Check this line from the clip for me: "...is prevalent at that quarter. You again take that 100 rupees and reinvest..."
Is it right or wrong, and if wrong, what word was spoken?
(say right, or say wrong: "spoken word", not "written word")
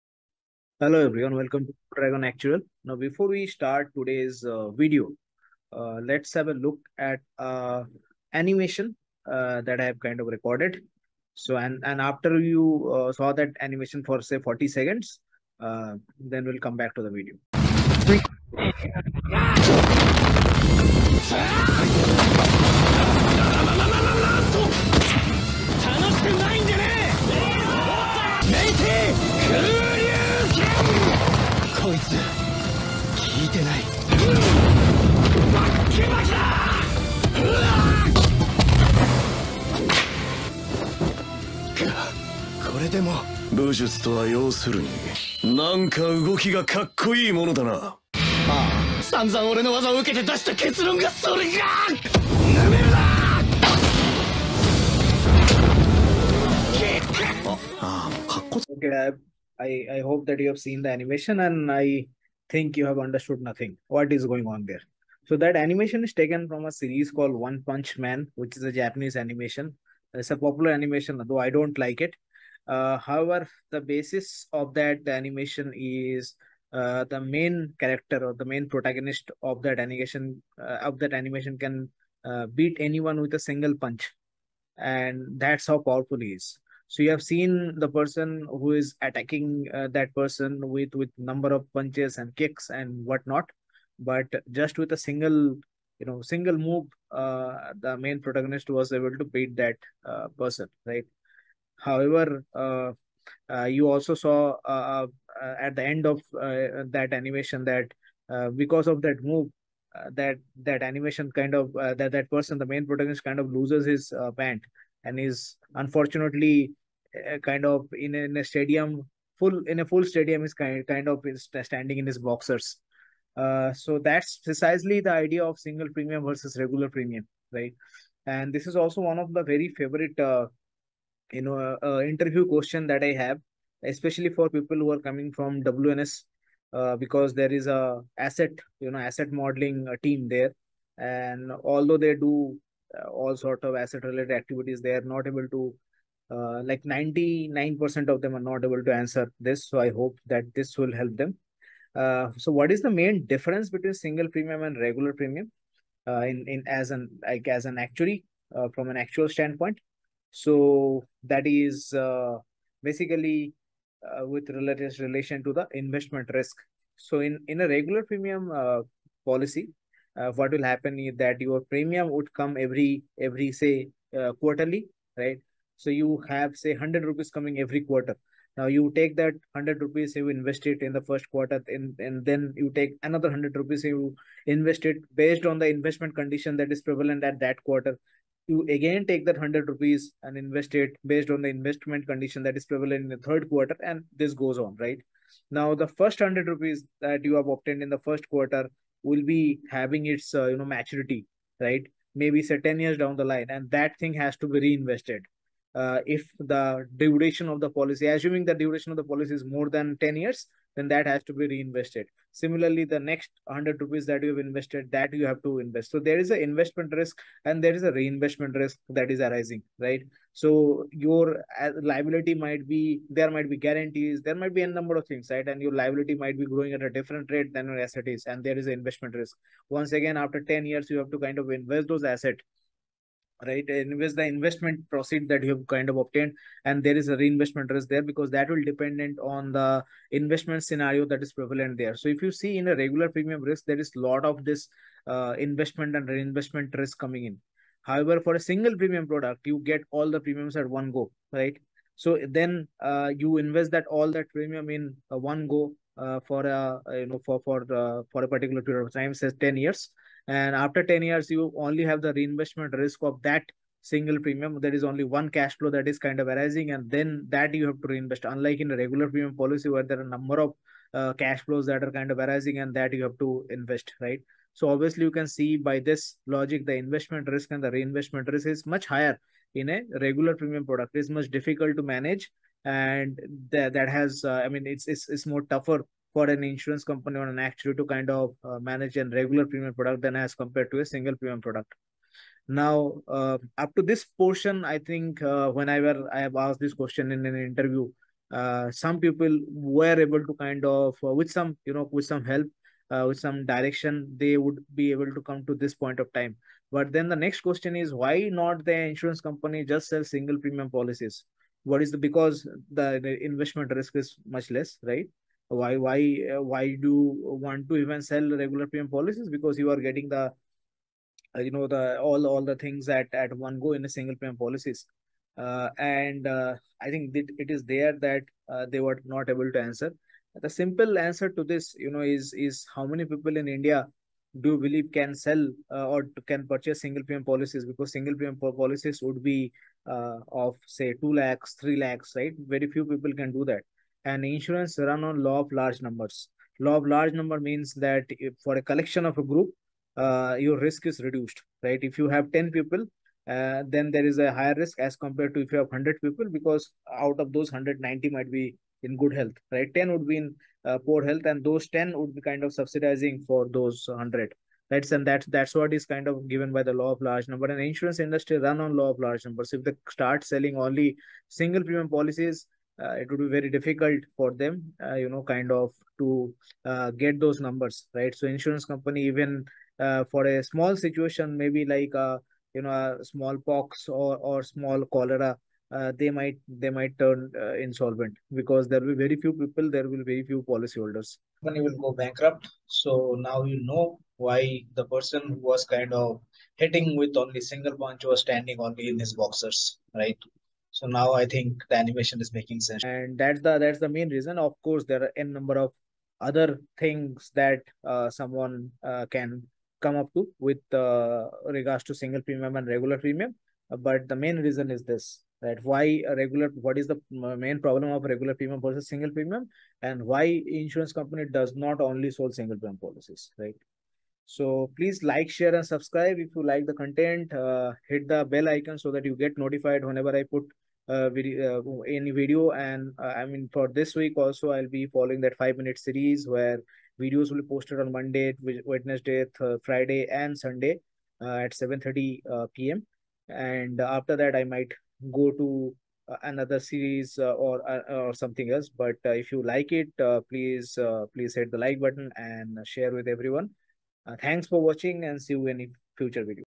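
wrong: "invest", not "reinvest".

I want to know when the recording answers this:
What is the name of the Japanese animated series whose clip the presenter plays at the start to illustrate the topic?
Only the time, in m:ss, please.
1:07.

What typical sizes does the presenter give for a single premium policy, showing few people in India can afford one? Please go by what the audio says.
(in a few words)
2 lakhs 3 lakhs.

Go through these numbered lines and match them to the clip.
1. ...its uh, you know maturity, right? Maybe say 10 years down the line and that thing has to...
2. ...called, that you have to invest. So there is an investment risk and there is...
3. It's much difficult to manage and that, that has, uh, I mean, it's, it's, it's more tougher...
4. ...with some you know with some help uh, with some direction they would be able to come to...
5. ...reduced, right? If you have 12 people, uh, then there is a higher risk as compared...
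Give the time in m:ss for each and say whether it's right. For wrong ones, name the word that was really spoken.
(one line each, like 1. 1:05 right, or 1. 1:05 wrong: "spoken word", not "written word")
1. 3:20 right
2. 3:34 wrong: "invested", not "called"
3. 4:40 right
4. 5:01 right
5. 5:51 wrong: "10", not "12".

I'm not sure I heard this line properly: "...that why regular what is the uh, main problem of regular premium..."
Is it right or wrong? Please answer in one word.
right.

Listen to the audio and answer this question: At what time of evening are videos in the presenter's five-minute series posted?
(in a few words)
7:30 p.m.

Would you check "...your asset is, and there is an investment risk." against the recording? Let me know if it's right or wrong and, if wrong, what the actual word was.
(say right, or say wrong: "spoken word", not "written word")
right.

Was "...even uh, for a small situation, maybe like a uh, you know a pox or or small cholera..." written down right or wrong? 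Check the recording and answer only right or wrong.
right.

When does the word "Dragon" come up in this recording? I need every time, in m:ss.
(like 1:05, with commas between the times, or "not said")
0:01.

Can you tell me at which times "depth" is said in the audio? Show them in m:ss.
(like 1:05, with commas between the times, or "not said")
not said.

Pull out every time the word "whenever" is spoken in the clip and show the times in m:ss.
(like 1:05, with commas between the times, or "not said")
4:55, 7:09.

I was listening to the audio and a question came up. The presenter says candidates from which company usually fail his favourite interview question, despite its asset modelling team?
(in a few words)
WNS.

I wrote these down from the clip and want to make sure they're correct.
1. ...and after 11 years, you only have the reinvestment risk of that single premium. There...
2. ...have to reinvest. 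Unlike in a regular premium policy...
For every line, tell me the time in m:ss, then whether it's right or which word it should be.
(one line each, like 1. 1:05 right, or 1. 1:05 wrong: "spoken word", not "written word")
1. 4:20 wrong: "10", not "11"
2. 4:27 right.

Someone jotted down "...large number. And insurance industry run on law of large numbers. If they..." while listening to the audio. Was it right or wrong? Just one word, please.
right.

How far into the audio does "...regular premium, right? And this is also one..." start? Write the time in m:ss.
2:06.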